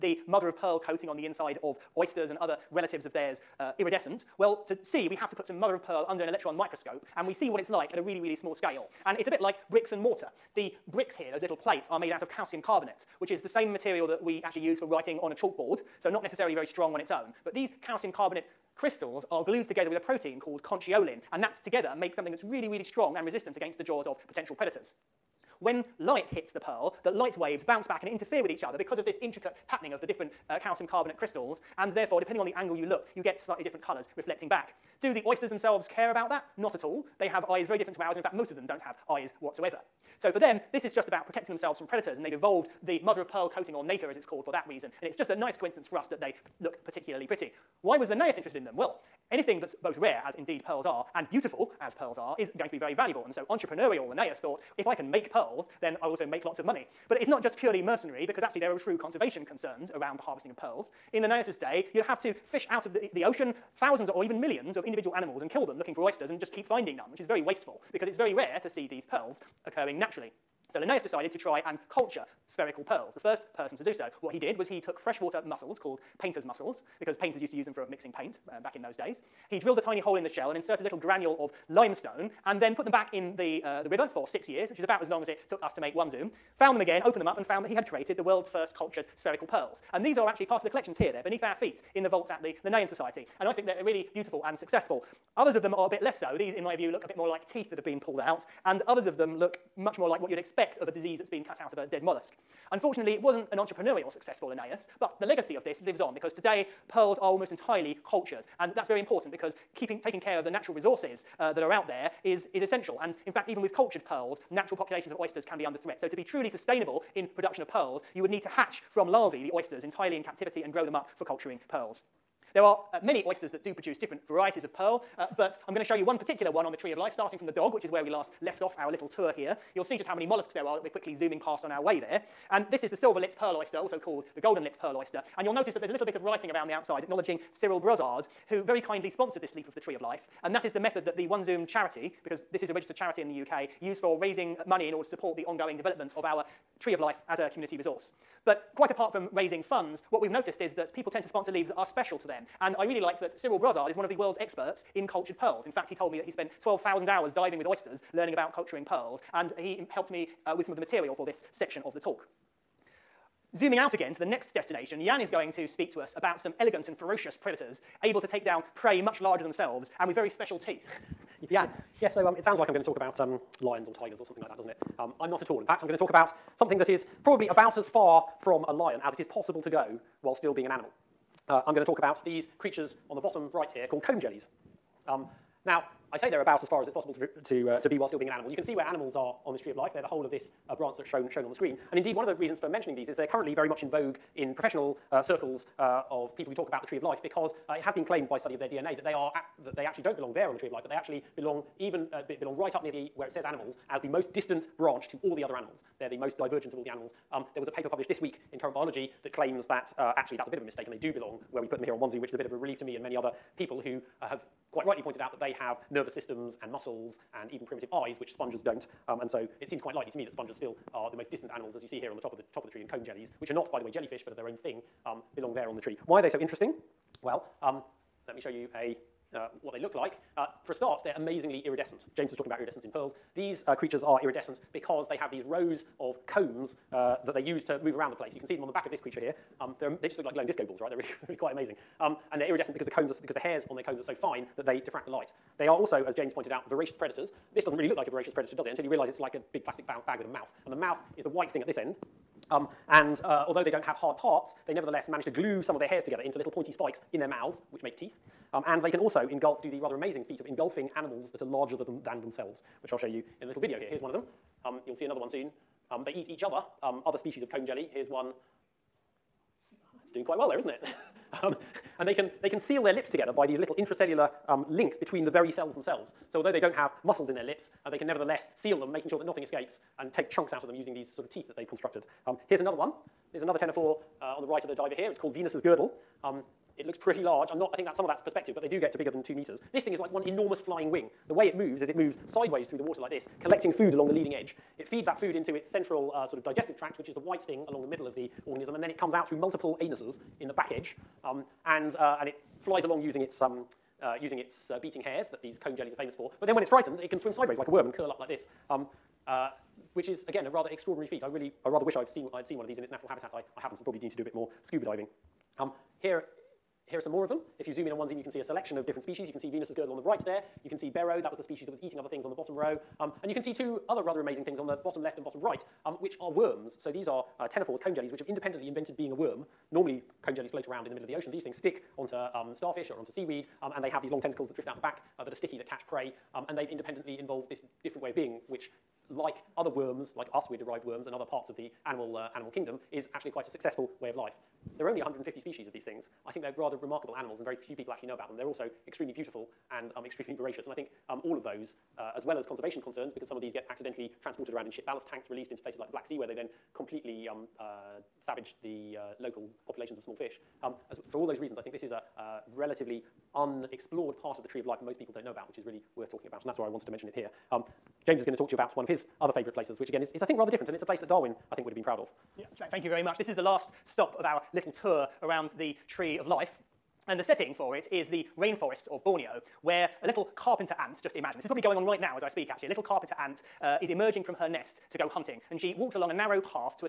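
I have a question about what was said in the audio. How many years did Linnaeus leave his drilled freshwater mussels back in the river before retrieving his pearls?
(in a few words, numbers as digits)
6.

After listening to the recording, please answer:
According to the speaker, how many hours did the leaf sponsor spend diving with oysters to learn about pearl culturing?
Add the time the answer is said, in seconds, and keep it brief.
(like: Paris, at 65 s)
12,000, at 156 s.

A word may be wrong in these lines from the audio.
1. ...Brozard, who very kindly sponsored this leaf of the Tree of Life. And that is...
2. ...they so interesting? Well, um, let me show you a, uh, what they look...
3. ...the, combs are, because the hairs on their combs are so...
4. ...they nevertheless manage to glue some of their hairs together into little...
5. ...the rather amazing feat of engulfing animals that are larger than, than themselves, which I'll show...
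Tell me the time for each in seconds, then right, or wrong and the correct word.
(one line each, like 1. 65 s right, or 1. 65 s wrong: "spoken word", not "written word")
1. 137 s right
2. 226 s right
3. 242 s right
4. 254 s right
5. 259 s right.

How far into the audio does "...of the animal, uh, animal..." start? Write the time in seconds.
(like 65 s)
341 s.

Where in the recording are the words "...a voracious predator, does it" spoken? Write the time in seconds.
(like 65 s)
248 s.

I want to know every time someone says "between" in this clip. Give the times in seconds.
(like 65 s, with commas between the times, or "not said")
274 s.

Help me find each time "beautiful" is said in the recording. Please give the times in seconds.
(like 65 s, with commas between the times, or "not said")
51 s, 94 s, 349 s.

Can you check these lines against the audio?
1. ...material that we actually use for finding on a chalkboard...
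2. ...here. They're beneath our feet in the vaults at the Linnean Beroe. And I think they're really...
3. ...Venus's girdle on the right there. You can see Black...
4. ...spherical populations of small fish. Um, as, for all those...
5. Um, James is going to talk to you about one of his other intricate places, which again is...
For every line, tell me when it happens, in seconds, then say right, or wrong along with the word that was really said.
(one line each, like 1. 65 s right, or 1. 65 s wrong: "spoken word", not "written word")
1. 13 s wrong: "writing", not "finding"
2. 90 s wrong: "Society", not "Beroe"
3. 319 s wrong: "Beroe", not "Black"
4. 359 s wrong: "local", not "spherical"
5. 367 s wrong: "favourite", not "intricate".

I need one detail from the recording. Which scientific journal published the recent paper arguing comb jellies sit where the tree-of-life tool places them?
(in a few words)
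Current Biology.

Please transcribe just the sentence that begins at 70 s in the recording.
So Linnaeus decided to try and culture spherical pearls, the first person to do so.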